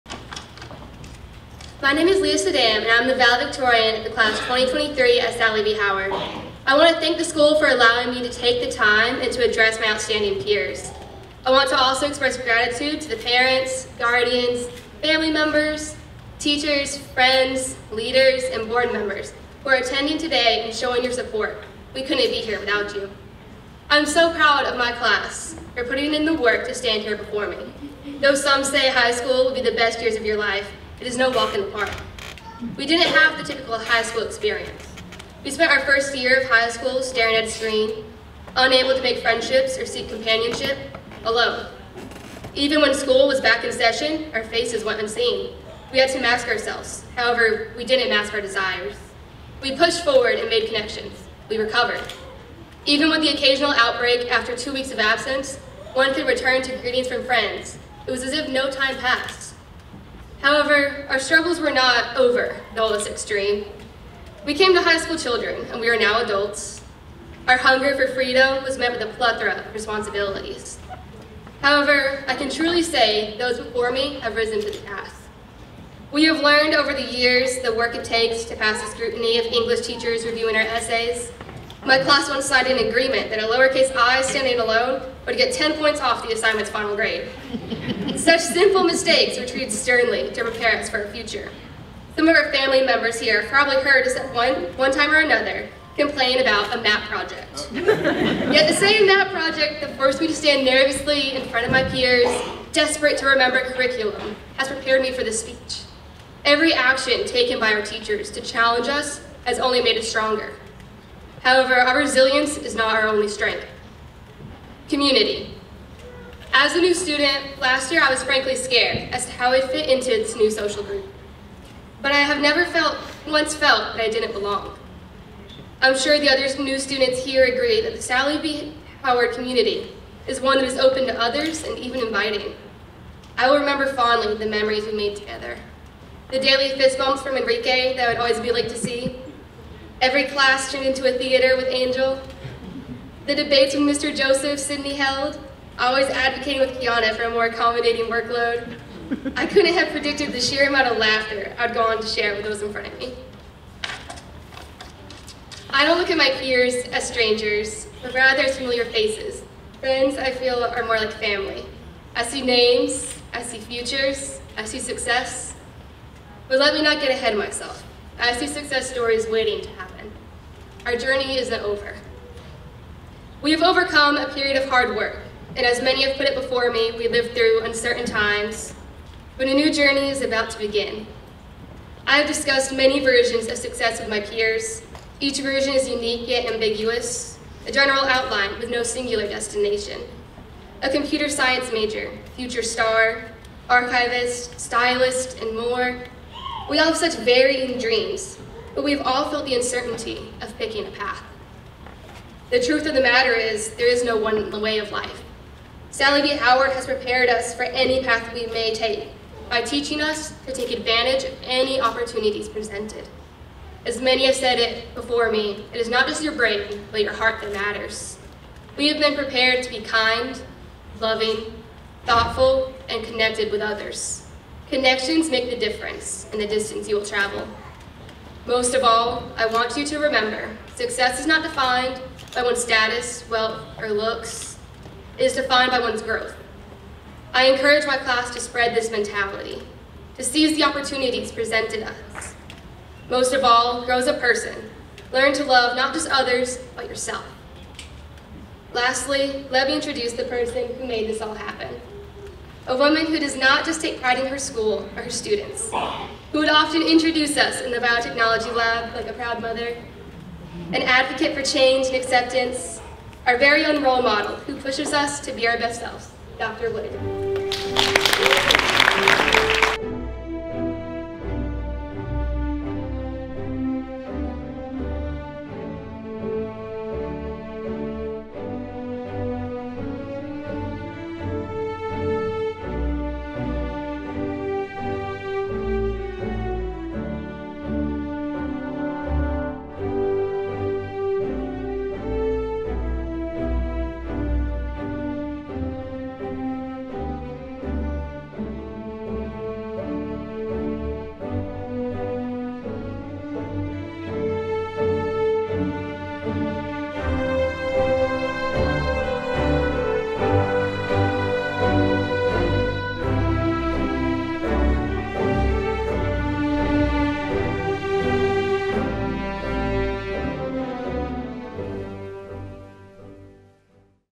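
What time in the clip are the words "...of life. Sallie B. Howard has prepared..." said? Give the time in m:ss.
3:24.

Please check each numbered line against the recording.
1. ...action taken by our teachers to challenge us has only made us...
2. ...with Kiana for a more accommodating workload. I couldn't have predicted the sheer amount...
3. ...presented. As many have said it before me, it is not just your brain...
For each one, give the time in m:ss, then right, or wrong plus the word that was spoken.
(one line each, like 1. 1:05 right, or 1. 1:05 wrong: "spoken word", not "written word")
1. 1:46 right
2. 2:26 right
3. 3:32 right.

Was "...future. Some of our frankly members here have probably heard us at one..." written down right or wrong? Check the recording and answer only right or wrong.
wrong.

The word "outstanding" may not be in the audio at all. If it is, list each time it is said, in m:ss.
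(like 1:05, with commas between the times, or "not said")
0:09.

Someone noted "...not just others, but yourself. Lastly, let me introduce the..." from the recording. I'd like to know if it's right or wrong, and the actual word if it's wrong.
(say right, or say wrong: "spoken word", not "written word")
right.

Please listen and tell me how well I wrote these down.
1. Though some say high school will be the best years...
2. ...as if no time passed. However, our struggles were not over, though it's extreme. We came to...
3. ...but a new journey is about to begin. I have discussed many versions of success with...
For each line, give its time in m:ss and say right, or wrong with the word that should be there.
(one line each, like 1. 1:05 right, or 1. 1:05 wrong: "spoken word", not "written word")
1. 0:28 right
2. 0:58 right
3. 2:59 right.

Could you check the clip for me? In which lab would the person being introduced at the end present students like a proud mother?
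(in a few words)
biotechnology lab.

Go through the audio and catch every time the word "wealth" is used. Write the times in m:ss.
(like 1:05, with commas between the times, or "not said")
3:53.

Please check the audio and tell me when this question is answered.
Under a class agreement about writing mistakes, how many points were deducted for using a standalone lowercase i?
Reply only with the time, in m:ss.
1:25.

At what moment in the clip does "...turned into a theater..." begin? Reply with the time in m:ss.
2:20.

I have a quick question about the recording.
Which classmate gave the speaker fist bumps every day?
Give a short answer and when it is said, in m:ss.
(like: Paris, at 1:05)
Enrique, at 2:17.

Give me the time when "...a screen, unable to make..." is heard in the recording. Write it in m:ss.
0:37.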